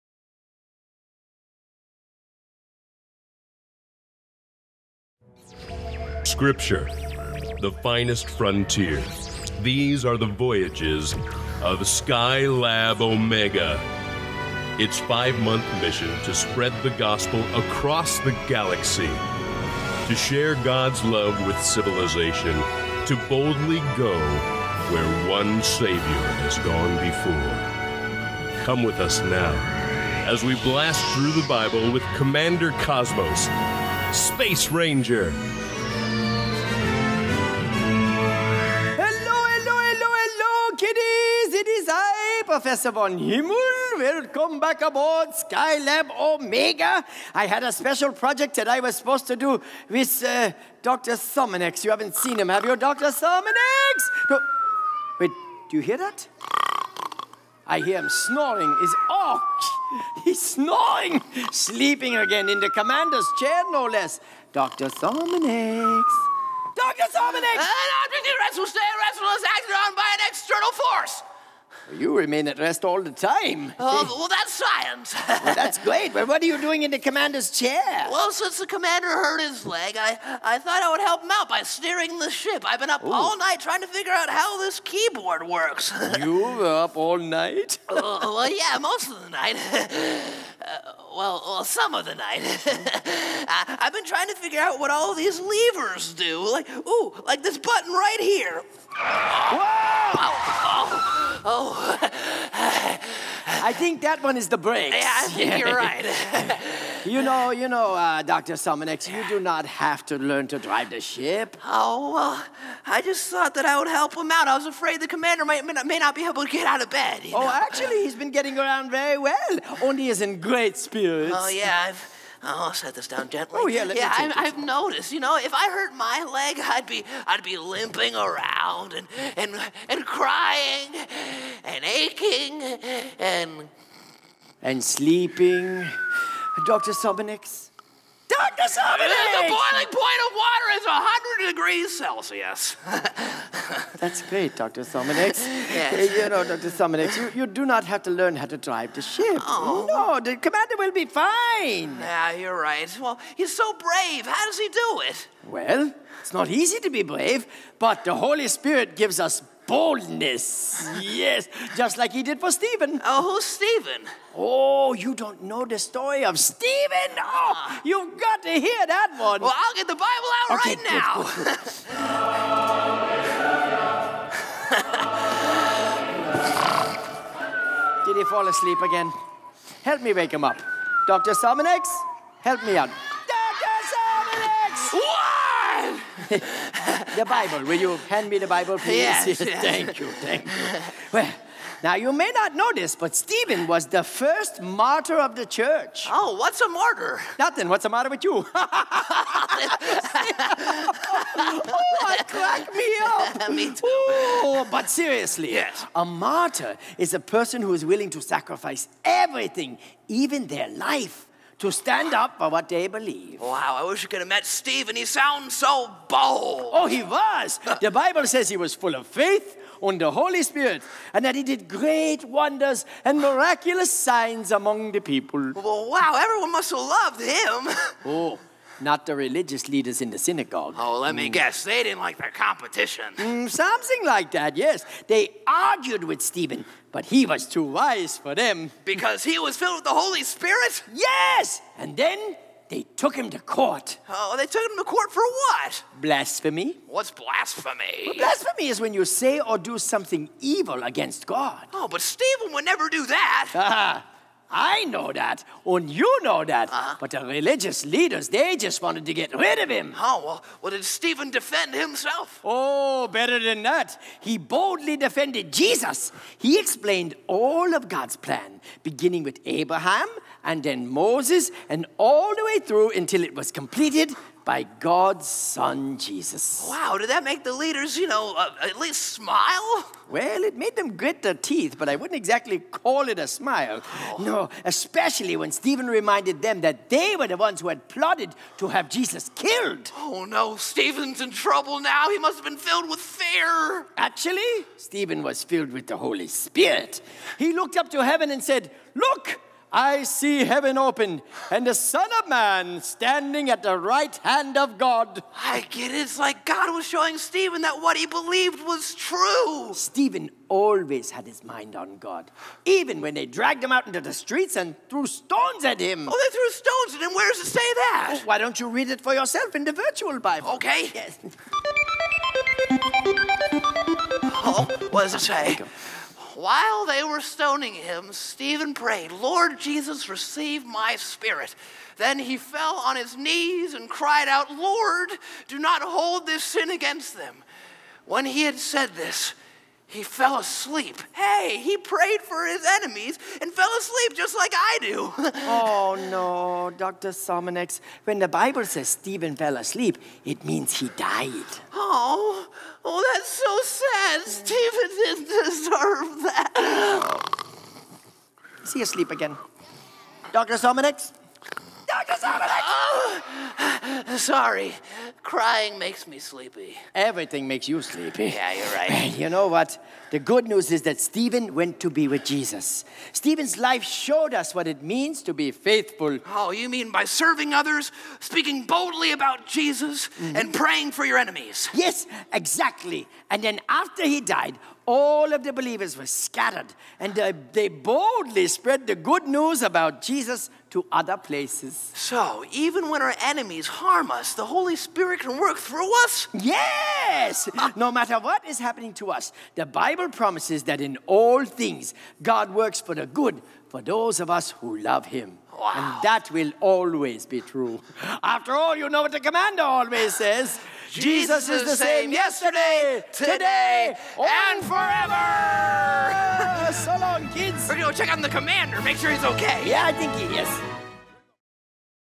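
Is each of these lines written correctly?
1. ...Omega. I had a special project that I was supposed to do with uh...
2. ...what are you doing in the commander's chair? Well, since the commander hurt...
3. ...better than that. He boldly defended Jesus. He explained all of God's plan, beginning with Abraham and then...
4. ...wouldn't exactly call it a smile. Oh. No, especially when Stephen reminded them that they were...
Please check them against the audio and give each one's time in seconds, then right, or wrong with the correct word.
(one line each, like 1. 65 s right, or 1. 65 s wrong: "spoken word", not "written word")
1. 46 s right
2. 76 s right
3. 263 s right
4. 281 s right.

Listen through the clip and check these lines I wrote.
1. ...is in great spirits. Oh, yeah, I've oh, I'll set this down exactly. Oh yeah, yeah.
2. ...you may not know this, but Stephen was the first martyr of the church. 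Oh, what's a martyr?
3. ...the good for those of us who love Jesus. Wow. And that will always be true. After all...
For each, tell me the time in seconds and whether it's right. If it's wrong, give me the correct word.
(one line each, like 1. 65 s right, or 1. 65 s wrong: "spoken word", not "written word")
1. 120 s wrong: "gently", not "exactly"
2. 191 s right
3. 402 s wrong: "Him", not "Jesus".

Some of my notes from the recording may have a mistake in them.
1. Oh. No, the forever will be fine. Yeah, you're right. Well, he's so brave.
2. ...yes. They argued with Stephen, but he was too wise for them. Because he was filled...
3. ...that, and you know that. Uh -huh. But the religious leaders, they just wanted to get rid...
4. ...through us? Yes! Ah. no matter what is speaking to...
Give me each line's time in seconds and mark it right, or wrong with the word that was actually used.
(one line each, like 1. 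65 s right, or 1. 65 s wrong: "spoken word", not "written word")
1. 149 s wrong: "commander", not "forever"
2. 234 s right
3. 255 s right
4. 395 s wrong: "happening", not "speaking".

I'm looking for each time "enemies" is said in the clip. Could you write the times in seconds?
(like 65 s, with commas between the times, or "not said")
342 s, 381 s, 393 s.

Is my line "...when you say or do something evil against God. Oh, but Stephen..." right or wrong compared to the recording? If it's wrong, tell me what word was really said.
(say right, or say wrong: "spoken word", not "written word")
right.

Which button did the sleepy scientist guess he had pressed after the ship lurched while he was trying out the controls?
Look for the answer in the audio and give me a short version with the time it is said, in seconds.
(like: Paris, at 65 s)
The brakes, at 104 s.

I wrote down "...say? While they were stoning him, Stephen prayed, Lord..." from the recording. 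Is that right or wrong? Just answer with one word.
right.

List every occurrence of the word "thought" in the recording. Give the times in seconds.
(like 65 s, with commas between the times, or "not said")
80 s, 113 s.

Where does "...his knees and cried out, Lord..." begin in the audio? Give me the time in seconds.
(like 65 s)
332 s.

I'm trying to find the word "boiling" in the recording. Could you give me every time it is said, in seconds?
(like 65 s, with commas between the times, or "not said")
139 s.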